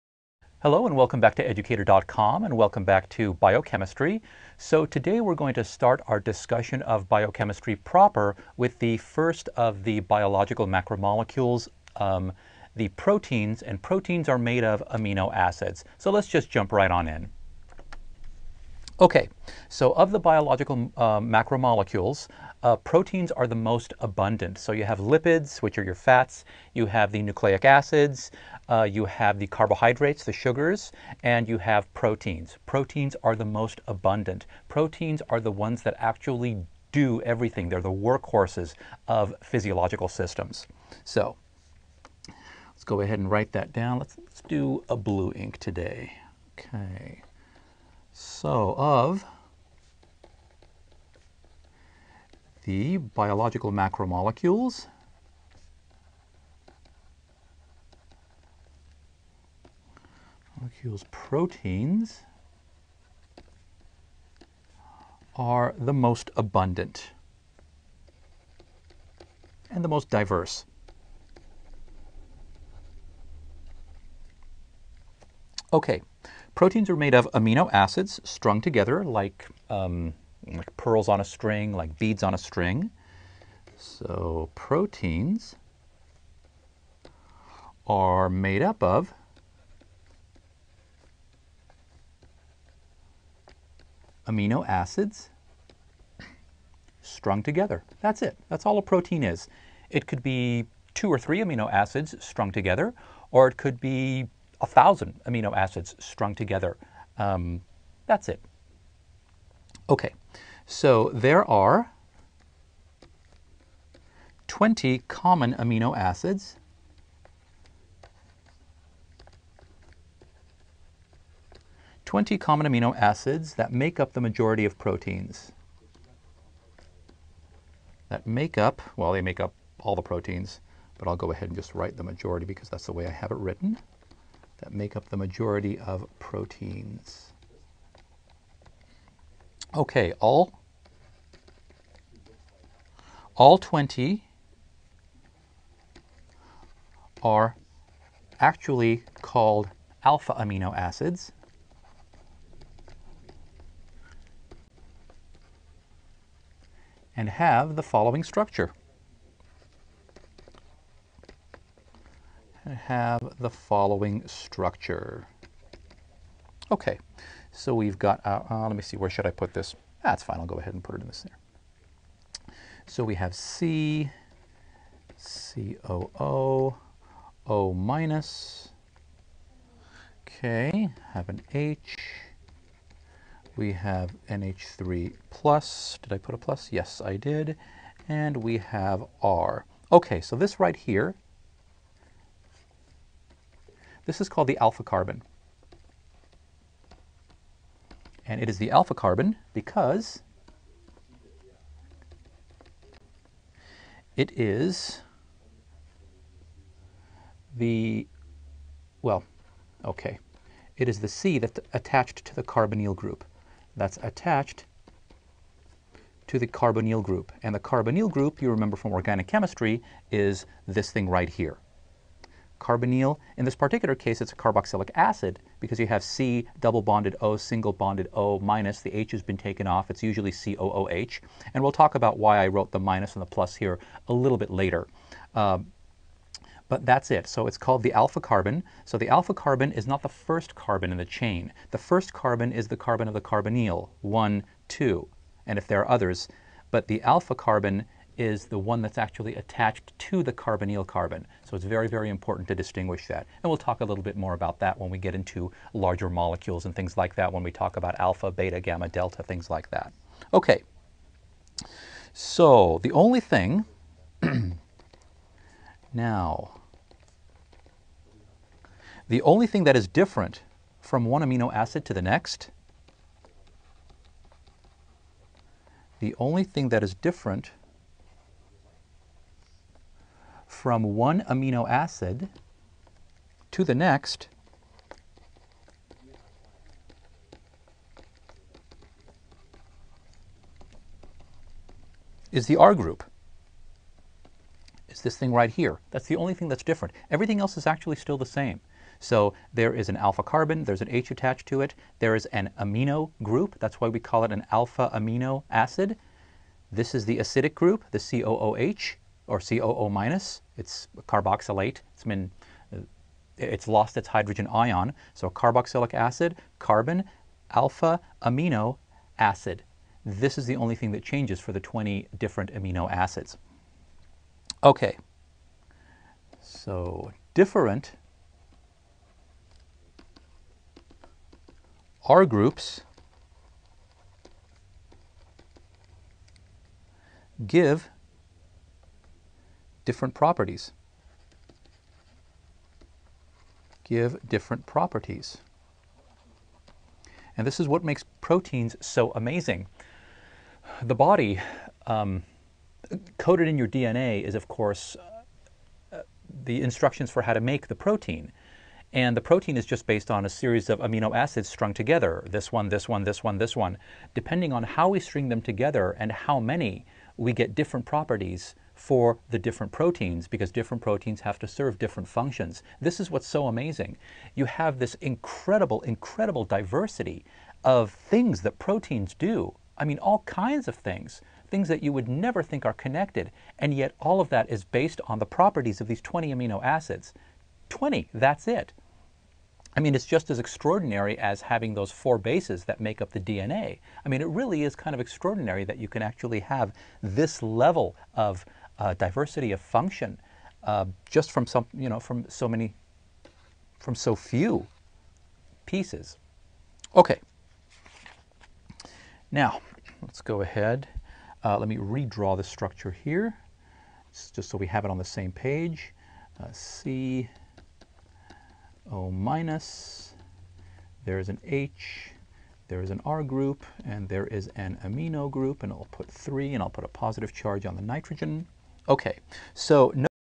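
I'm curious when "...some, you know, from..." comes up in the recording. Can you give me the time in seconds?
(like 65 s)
401 s.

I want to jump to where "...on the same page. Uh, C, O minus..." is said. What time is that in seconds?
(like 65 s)
414 s.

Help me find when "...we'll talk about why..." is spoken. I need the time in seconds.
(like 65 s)
231 s.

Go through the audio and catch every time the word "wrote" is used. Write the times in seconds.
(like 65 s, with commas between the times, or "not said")
232 s.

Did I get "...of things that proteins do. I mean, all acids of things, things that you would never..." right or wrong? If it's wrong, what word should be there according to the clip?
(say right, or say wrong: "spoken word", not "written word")
wrong: "kinds", not "acids".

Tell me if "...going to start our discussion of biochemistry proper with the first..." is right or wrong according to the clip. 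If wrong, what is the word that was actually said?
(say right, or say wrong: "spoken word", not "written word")
right.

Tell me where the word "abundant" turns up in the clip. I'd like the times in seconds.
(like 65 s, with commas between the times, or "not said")
23 s, 33 s, 66 s.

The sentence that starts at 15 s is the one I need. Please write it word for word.
So let's just jump right on in.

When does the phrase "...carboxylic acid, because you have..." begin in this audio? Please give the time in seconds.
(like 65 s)
224 s.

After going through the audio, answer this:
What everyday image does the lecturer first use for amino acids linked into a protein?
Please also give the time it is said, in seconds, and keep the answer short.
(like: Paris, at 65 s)
Pearls on a string, at 80 s.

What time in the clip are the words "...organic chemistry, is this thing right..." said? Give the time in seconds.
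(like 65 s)
218 s.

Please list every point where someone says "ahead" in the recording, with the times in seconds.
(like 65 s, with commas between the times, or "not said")
43 s, 131 s, 170 s, 410 s.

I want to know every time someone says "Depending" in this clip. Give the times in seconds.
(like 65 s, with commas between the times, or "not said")
364 s.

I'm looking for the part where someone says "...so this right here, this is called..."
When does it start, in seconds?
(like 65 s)
190 s.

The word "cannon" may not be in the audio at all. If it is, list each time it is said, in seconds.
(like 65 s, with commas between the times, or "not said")
not said.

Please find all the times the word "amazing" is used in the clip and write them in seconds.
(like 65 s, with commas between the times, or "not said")
349 s, 373 s.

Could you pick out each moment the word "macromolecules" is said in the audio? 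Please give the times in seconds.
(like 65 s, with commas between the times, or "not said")
10 s, 21 s, 53 s.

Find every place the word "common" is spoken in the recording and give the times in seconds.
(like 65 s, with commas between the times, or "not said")
115 s, 122 s.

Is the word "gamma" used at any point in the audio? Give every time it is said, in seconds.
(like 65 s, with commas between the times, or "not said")
258 s.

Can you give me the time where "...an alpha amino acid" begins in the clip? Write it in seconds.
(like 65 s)
304 s.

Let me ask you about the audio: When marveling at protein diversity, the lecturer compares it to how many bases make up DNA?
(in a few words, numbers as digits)
4.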